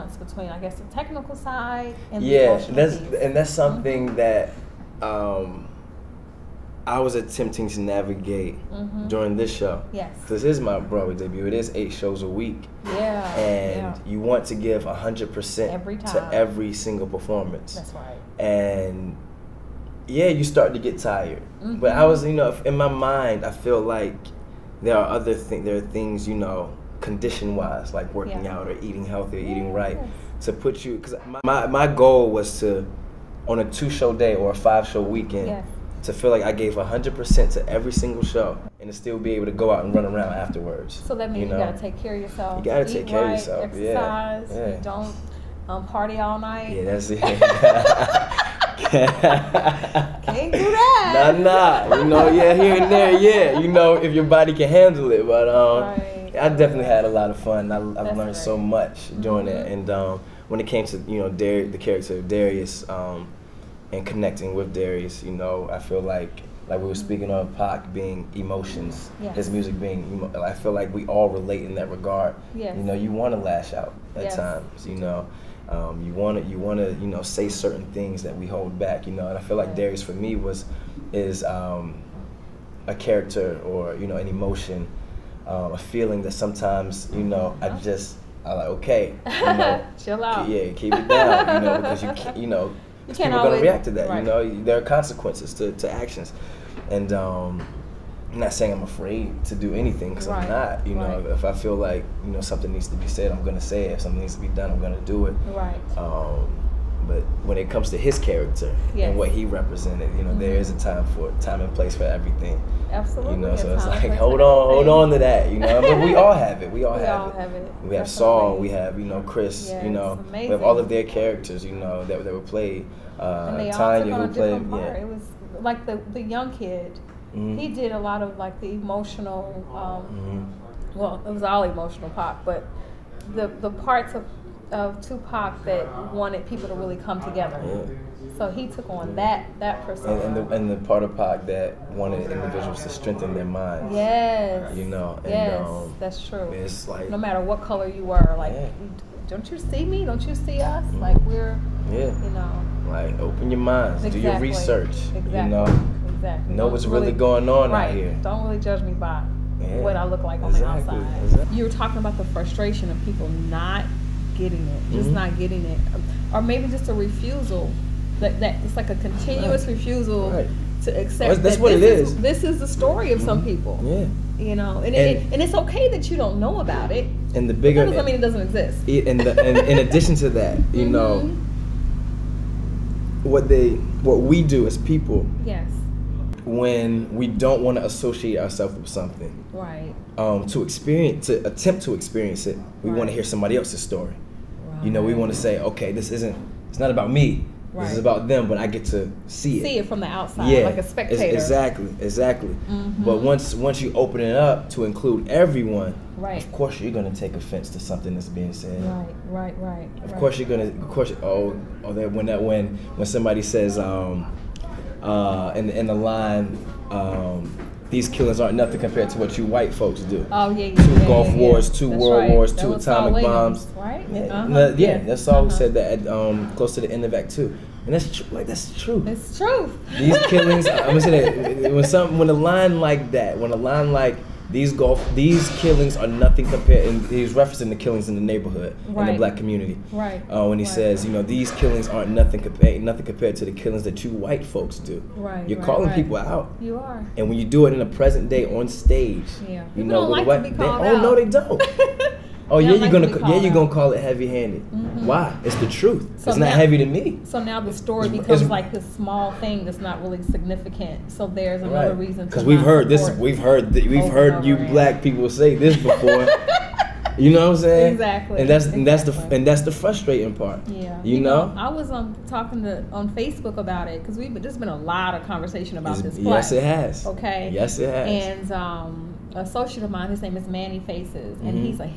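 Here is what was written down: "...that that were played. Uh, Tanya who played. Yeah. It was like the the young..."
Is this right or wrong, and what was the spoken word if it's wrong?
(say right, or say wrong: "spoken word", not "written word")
right.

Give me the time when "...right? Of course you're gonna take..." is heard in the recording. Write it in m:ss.
3:26.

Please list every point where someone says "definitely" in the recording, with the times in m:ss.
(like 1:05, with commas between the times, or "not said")
0:56, 1:57.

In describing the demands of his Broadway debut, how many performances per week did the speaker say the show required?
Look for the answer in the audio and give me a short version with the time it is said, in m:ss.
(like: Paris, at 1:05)
8, at 0:11.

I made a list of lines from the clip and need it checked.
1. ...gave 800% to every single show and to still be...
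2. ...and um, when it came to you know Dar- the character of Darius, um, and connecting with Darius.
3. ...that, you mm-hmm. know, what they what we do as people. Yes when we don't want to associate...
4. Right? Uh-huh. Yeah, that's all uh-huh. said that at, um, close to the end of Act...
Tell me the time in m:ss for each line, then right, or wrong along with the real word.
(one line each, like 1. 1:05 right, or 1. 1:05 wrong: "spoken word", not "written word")
1. 0:36 wrong: "100", not "800"
2. 0:59 right
3. 3:00 right
4. 3:43 right.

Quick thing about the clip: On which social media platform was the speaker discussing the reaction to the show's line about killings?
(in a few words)
Facebook.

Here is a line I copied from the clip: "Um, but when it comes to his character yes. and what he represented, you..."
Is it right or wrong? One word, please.
right.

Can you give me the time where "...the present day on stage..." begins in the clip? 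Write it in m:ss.
4:07.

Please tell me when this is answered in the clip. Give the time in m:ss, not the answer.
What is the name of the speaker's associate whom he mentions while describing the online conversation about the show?
4:40.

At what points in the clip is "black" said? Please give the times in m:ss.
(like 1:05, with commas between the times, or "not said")
3:59, 4:24.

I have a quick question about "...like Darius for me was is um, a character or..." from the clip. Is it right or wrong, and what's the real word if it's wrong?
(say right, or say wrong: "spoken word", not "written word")
right.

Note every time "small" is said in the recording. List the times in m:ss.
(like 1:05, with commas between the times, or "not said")
4:18.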